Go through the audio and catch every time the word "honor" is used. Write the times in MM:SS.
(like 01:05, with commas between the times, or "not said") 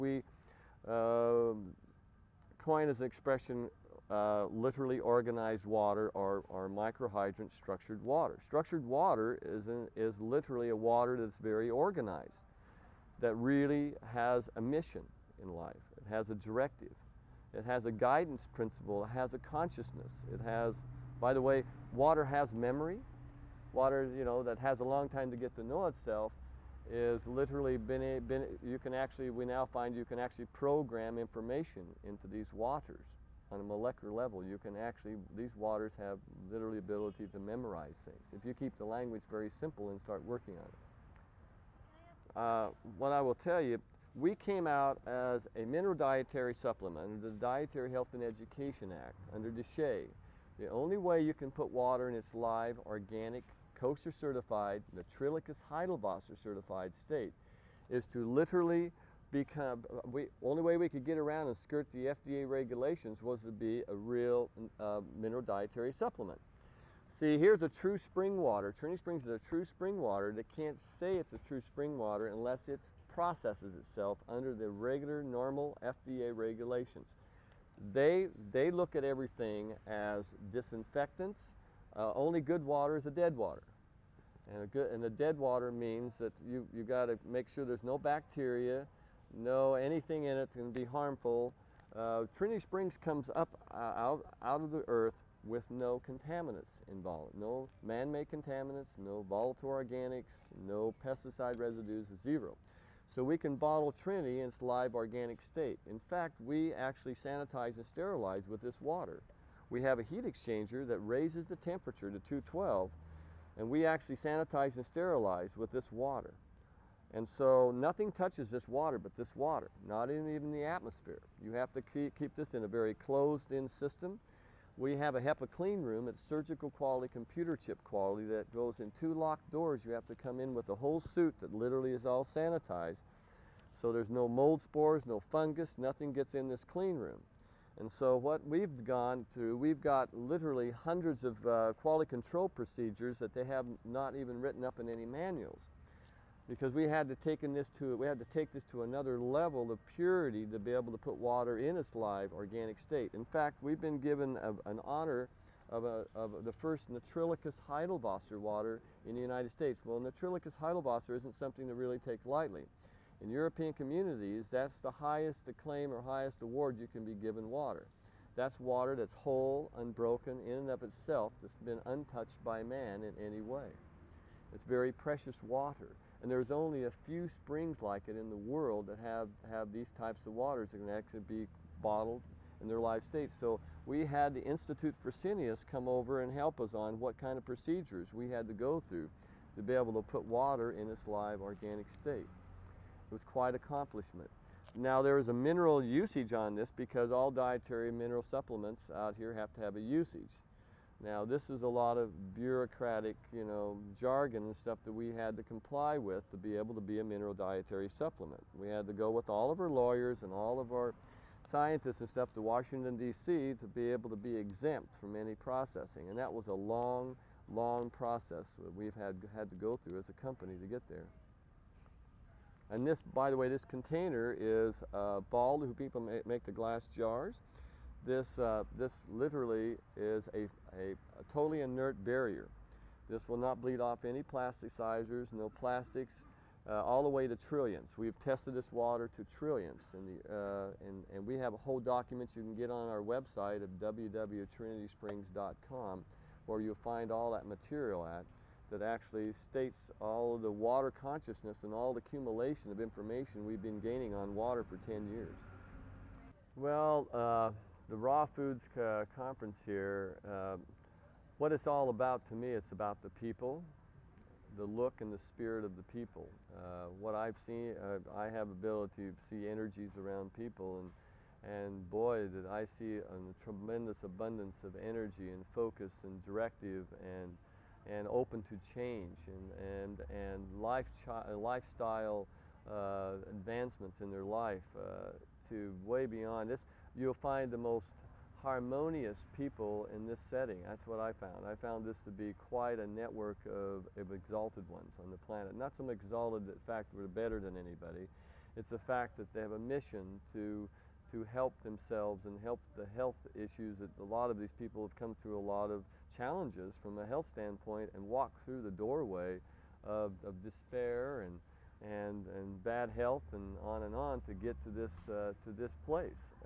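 02:34.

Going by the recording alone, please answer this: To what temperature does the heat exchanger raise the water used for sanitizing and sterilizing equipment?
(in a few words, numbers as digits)
212.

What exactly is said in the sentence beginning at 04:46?
You'll find the most harmonious people in this setting.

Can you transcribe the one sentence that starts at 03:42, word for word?
And this, by the way, this container is uh, Ball, who people make, make the glass jars.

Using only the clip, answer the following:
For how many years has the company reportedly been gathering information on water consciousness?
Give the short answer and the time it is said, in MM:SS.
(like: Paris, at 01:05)
10, at 04:14.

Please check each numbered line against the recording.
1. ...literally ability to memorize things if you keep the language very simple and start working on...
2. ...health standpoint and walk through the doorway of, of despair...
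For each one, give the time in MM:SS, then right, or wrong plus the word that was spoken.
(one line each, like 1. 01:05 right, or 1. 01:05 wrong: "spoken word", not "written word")
1. 00:36 right
2. 05:07 right.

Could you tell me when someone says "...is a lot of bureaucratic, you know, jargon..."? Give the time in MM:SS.
03:21.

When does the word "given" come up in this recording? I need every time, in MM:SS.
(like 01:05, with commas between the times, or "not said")
02:33, 02:47.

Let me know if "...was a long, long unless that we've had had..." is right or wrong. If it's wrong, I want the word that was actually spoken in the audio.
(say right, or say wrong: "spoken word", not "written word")
wrong: "process", not "unless".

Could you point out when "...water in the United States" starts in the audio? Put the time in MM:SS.
02:38.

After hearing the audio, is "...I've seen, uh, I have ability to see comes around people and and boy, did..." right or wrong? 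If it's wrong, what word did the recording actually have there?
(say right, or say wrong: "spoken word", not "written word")
wrong: "energies", not "comes".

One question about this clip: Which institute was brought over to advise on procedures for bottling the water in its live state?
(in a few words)
Institute for Fresenius.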